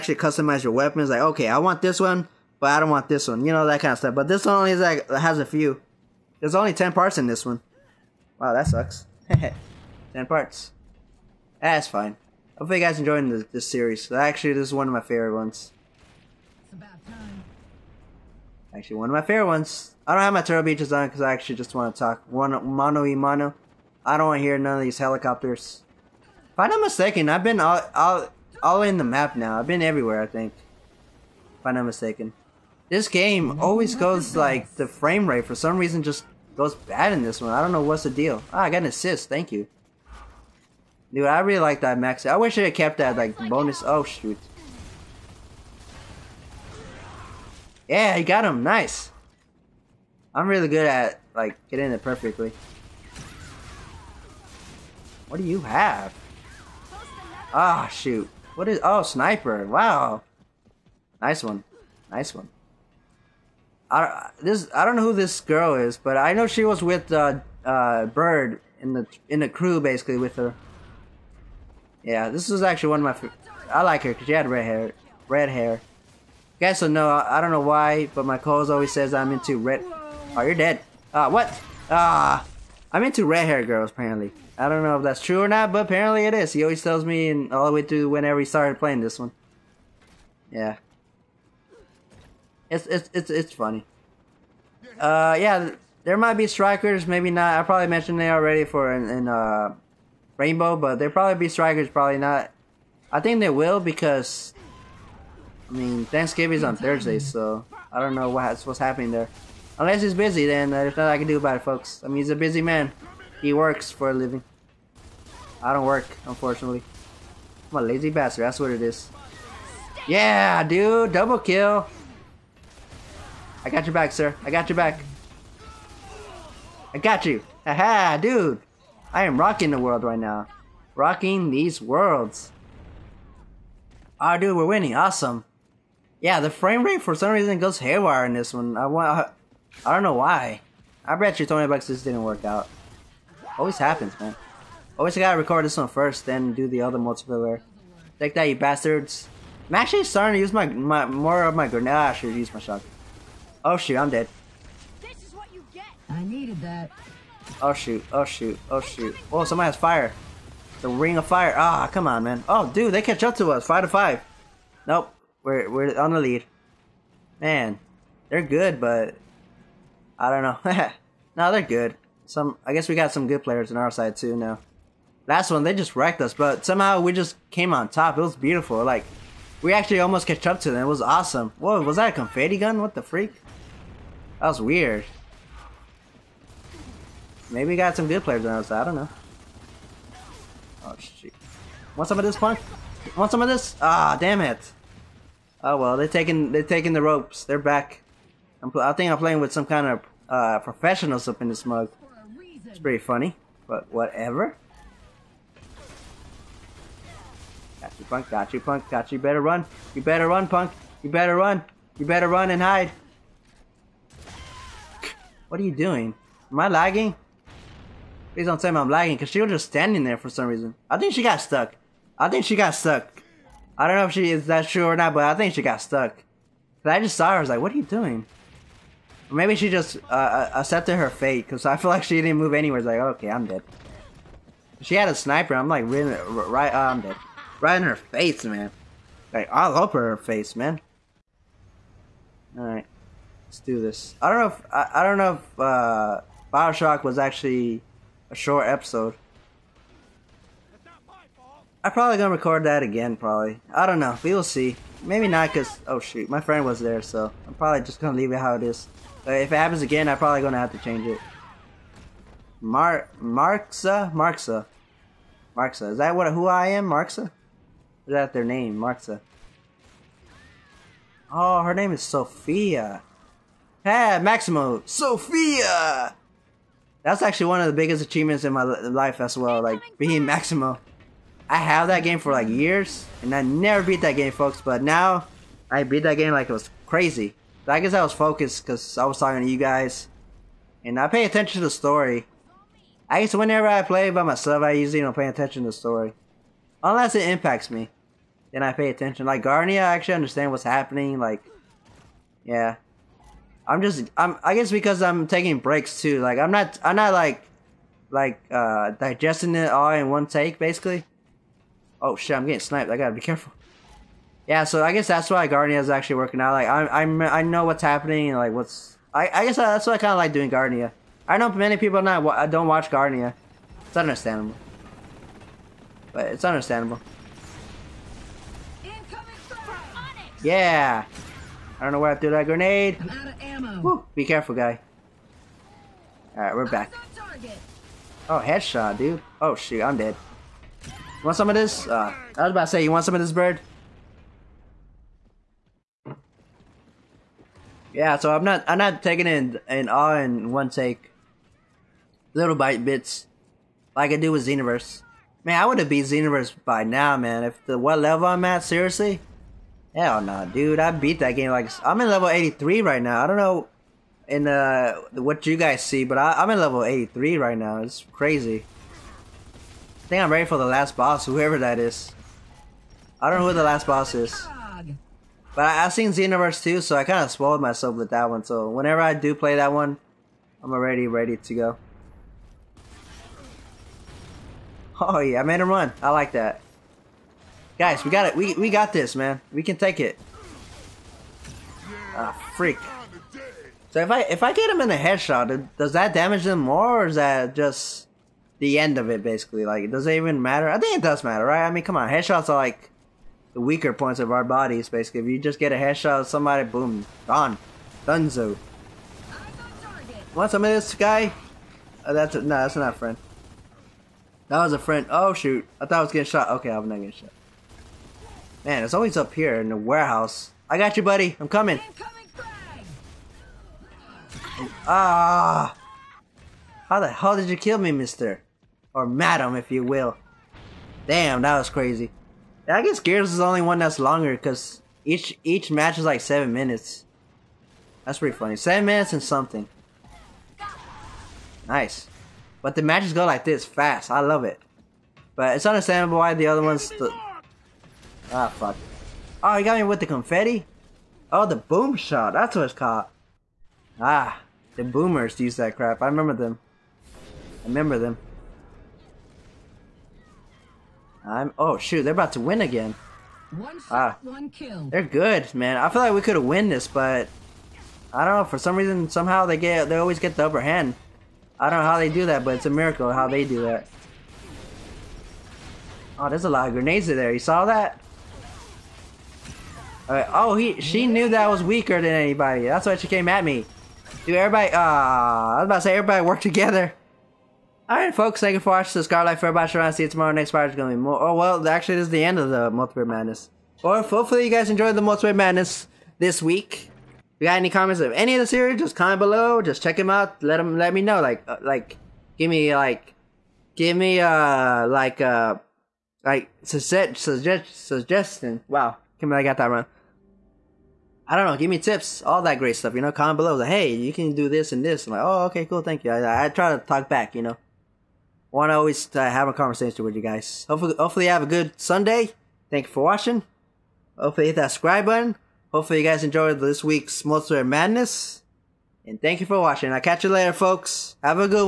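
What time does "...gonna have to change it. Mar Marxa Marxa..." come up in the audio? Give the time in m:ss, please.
4:20.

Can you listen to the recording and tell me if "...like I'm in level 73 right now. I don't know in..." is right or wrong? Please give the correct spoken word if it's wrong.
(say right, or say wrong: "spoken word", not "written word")
wrong: "83", not "73".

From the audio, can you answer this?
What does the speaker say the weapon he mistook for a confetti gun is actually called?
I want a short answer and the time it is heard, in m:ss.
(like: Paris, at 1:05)
boom shot, at 7:31.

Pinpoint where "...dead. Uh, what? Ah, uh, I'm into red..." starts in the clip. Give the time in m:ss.
1:20.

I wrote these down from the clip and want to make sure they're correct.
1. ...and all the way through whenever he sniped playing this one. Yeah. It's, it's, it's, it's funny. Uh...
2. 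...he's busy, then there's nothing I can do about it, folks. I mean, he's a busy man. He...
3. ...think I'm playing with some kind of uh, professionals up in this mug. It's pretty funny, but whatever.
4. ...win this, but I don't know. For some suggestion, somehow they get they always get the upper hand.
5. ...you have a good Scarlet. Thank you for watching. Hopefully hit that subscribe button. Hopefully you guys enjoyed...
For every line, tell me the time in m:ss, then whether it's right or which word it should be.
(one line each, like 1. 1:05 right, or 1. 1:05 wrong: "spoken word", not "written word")
1. 1:27 wrong: "started", not "sniped"
2. 1:50 right
3. 3:18 right
4. 7:46 wrong: "reason", not "suggestion"
5. 8:41 wrong: "Sunday", not "Scarlet".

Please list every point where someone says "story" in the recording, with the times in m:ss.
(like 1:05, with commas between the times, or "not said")
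4:51, 4:55.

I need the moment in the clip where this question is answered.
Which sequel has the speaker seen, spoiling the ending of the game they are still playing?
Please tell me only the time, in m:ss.
6:16.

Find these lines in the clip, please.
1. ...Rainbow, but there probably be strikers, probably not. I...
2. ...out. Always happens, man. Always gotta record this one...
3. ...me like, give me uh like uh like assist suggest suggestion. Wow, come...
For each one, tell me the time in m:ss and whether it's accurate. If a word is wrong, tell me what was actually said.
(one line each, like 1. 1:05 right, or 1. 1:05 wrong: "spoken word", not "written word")
1. 1:40 right
2. 2:22 right
3. 8:22 wrong: "suggest", not "assist".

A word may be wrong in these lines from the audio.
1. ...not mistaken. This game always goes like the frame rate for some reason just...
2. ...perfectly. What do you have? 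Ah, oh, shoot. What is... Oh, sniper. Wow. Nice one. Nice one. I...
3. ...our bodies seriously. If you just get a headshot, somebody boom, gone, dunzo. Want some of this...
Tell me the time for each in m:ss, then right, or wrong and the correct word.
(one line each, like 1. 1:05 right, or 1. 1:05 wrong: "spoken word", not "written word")
1. 0:31 right
2. 0:52 right
3. 6:44 wrong: "basically", not "seriously".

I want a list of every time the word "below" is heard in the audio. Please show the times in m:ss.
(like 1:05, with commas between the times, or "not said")
8:19, 8:33.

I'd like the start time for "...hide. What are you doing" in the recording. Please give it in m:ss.
3:32.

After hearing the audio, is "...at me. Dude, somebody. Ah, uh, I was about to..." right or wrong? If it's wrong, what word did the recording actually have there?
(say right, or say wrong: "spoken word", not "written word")
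wrong: "everybody", not "somebody".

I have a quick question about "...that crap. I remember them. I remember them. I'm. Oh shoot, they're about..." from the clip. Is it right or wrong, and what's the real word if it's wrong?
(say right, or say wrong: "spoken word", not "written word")
right.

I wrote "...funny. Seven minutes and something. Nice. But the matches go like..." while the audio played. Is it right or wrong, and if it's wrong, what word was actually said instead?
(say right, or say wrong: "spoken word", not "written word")
right.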